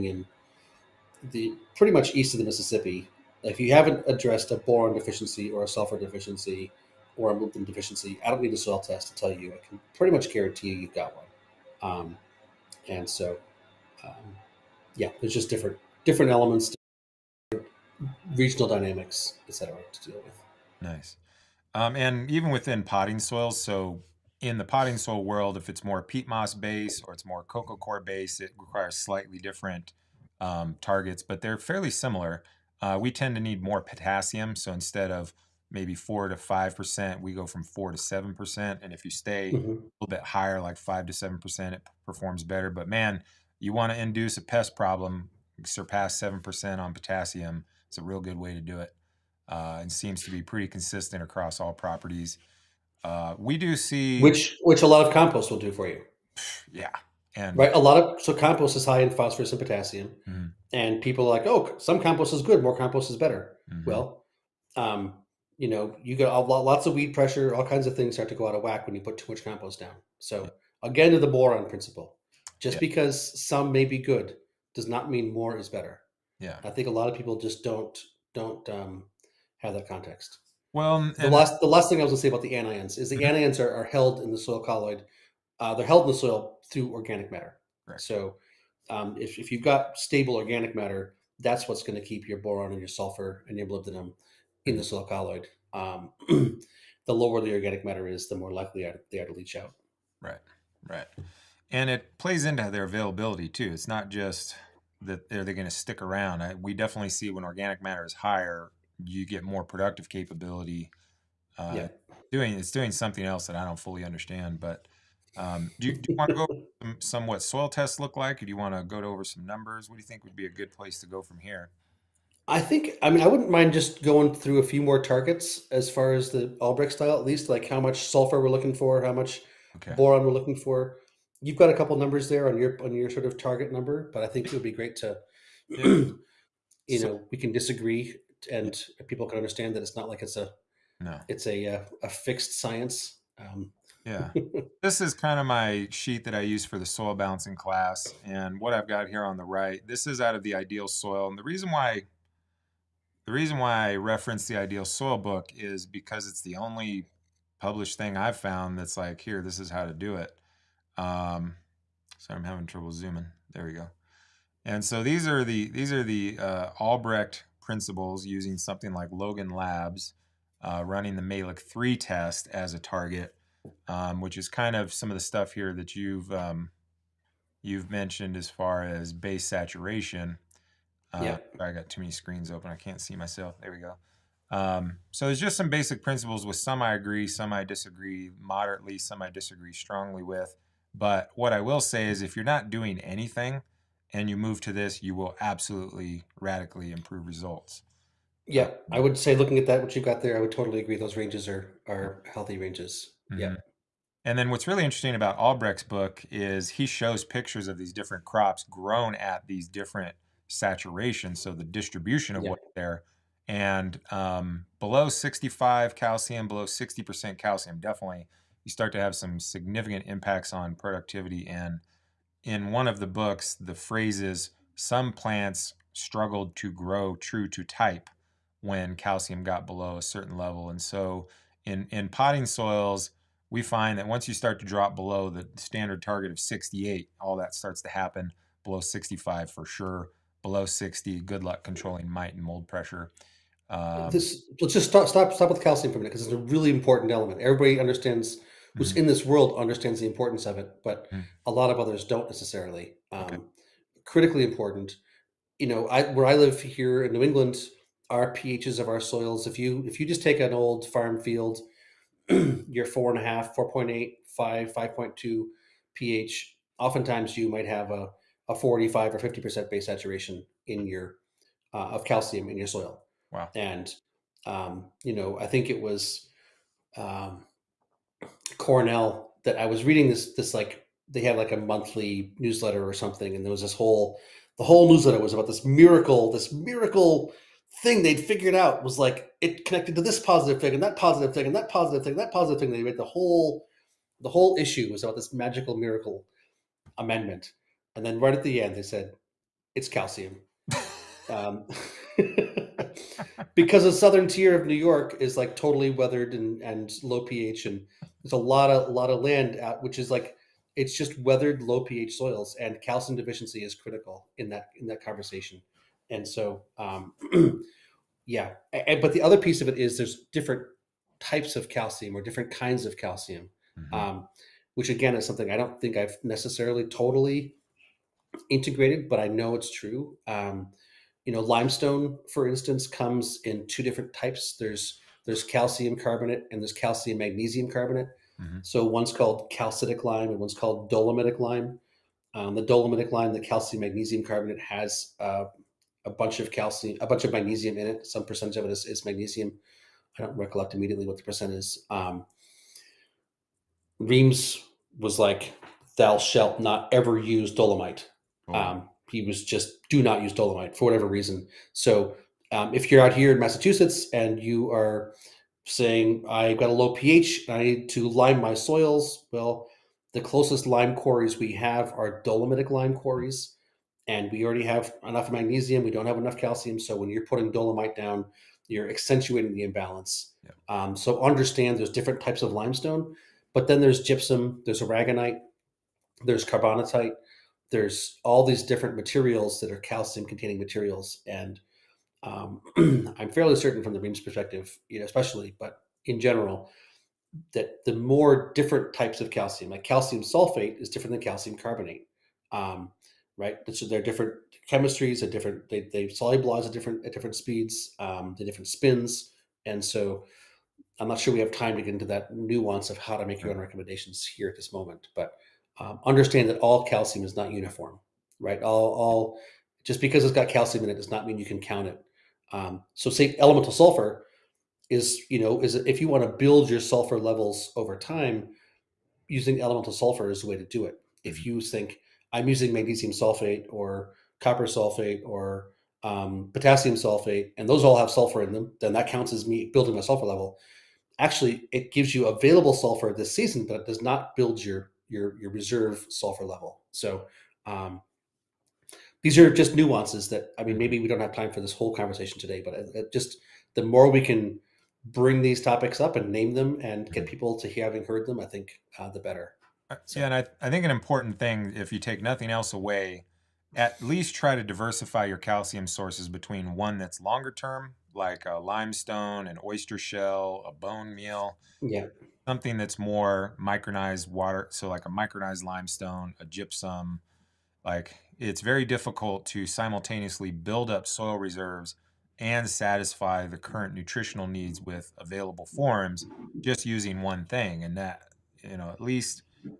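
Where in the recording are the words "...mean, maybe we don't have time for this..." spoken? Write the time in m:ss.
7:30.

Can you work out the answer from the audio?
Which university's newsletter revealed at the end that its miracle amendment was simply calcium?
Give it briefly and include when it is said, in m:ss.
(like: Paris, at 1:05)
Cornell, at 4:38.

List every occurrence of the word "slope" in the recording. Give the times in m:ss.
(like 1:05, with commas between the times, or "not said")
not said.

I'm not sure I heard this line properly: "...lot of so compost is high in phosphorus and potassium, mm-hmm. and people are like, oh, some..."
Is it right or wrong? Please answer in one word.
right.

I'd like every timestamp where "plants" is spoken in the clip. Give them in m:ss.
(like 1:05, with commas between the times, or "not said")
3:45.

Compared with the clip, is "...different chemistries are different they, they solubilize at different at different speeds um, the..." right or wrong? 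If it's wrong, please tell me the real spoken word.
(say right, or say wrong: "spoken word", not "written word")
right.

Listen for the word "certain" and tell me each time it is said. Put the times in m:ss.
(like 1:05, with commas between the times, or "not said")
3:50, 6:33.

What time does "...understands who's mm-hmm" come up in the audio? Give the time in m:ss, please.
4:07.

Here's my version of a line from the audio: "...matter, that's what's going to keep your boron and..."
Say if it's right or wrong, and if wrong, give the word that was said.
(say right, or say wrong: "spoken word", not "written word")
right.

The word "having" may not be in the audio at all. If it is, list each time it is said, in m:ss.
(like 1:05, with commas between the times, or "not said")
2:42, 7:37.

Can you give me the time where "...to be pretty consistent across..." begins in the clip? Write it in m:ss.
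0:50.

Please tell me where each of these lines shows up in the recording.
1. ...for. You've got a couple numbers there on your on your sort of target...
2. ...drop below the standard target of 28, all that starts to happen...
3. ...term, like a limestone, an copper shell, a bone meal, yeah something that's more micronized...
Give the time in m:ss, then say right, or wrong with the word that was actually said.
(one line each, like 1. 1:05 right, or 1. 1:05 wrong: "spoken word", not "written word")
1. 2:10 right
2. 3:54 wrong: "68", not "28"
3. 7:47 wrong: "oyster", not "copper".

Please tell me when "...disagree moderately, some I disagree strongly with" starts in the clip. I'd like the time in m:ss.
3:07.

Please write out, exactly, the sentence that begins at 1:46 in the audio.
I, we definitely see when organic matter is higher, you get more productive capability.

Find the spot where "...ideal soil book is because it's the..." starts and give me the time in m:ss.
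2:34.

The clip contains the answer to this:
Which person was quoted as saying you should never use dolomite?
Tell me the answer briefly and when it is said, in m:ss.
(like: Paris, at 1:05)
Reams, at 5:53.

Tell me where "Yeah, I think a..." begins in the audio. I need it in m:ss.
1:16.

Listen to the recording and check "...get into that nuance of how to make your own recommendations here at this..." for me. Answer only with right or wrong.
right.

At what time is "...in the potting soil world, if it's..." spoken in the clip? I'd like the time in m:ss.
0:24.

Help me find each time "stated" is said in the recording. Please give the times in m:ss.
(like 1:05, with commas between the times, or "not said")
not said.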